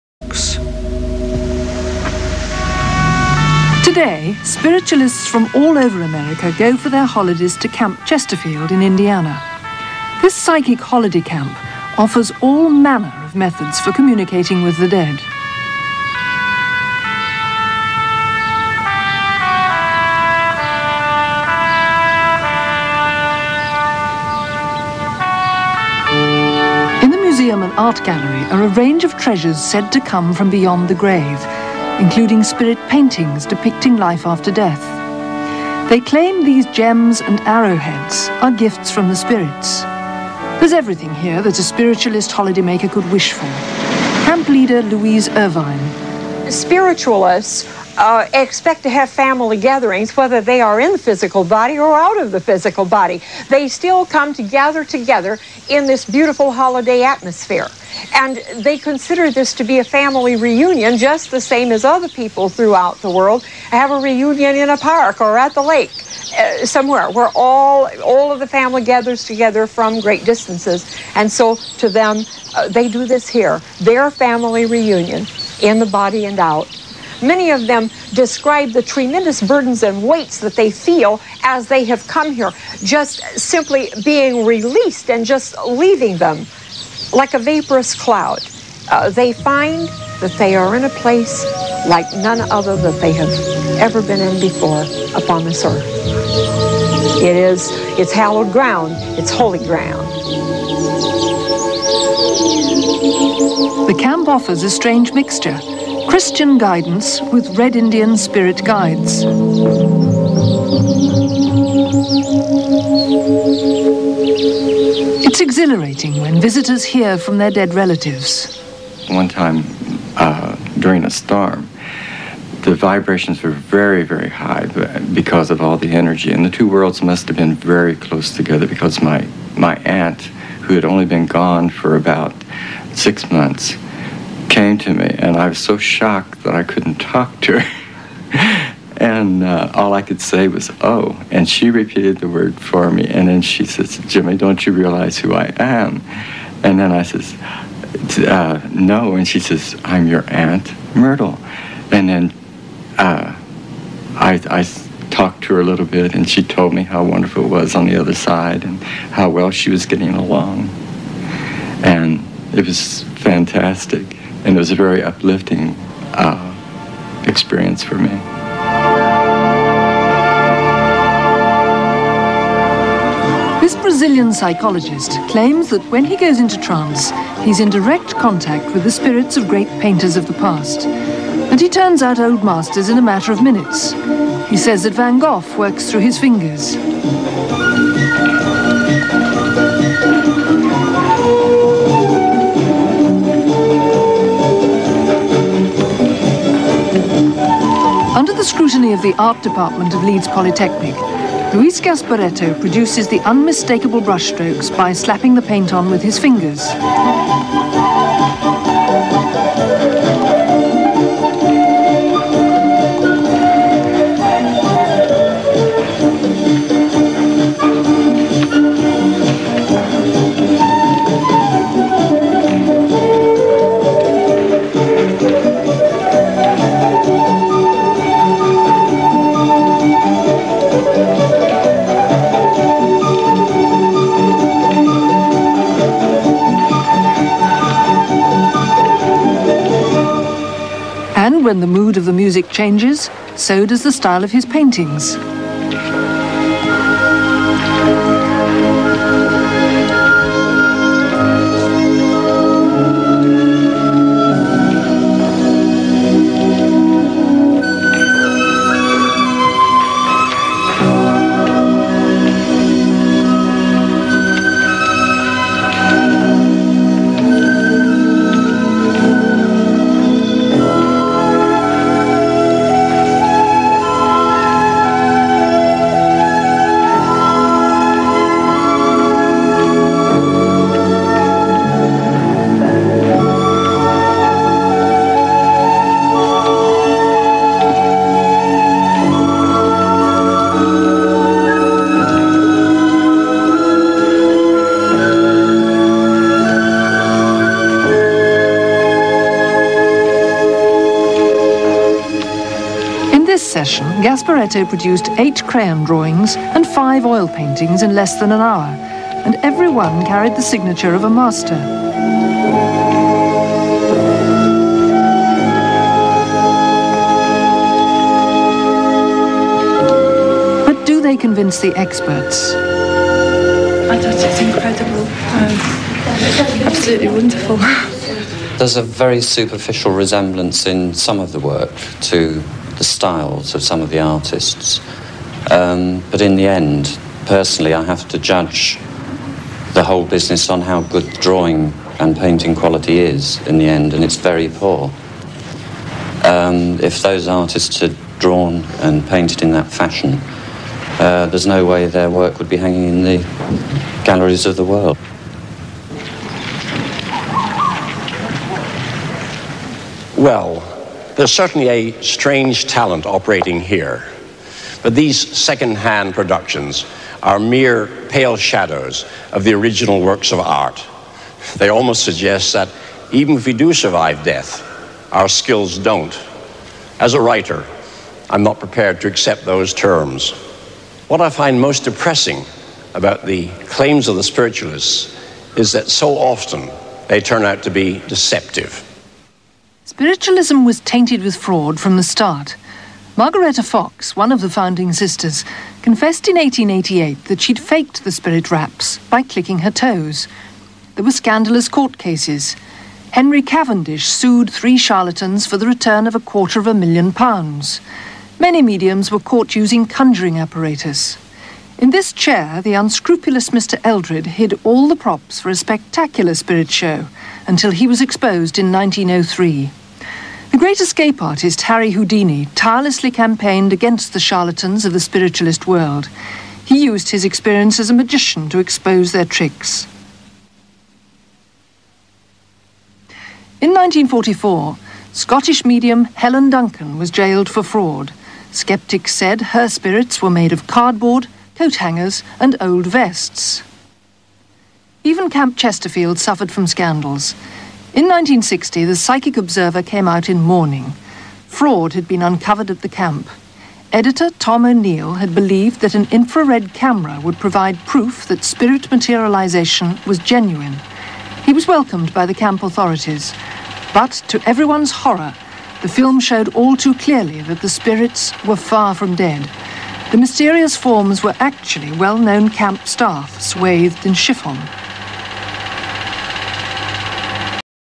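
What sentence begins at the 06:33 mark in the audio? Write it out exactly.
Margaretta Fox, one of the founding sisters, confessed in 1888 that she'd faked the spirit raps by clicking her toes.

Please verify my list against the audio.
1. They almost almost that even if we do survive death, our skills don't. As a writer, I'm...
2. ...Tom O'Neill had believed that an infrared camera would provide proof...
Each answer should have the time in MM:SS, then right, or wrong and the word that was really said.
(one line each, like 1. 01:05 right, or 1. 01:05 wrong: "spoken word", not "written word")
1. 06:11 wrong: "suggest", not "almost"
2. 07:34 right.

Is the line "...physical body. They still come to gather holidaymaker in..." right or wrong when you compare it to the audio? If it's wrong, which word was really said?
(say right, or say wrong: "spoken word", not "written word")
wrong: "together", not "holidaymaker".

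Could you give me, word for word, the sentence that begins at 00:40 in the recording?
There's everything here that a spiritualist holidaymaker could wish for.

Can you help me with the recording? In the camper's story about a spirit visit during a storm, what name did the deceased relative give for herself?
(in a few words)
Myrtle.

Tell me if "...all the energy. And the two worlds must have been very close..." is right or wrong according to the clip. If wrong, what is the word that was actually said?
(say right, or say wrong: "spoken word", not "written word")
right.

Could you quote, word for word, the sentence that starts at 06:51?
In this chair, the unscrupulous Mr.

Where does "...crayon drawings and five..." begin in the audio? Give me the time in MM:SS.
05:05.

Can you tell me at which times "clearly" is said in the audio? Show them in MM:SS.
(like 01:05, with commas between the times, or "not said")
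07:46.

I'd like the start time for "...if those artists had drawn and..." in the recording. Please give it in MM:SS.
05:46.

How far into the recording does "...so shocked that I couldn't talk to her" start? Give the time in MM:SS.
02:15.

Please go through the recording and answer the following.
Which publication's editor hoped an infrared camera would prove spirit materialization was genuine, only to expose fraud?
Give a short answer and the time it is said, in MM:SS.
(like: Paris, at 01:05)
Psychic Observer, at 07:28.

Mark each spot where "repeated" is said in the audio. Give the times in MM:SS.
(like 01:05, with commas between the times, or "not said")
02:21.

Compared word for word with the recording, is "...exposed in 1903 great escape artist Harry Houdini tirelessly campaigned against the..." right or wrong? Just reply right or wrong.
right.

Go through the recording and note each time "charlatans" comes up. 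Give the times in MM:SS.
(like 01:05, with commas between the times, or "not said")
06:44, 07:04.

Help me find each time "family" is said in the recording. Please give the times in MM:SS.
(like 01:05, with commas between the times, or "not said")
00:49, 00:59, 01:08, 01:14.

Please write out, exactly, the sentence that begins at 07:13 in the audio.
In 1944, Scottish medium Helen Duncan was jailed for fraud.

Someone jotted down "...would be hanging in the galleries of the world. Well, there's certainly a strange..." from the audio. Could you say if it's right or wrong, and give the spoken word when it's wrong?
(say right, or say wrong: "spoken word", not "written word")
right.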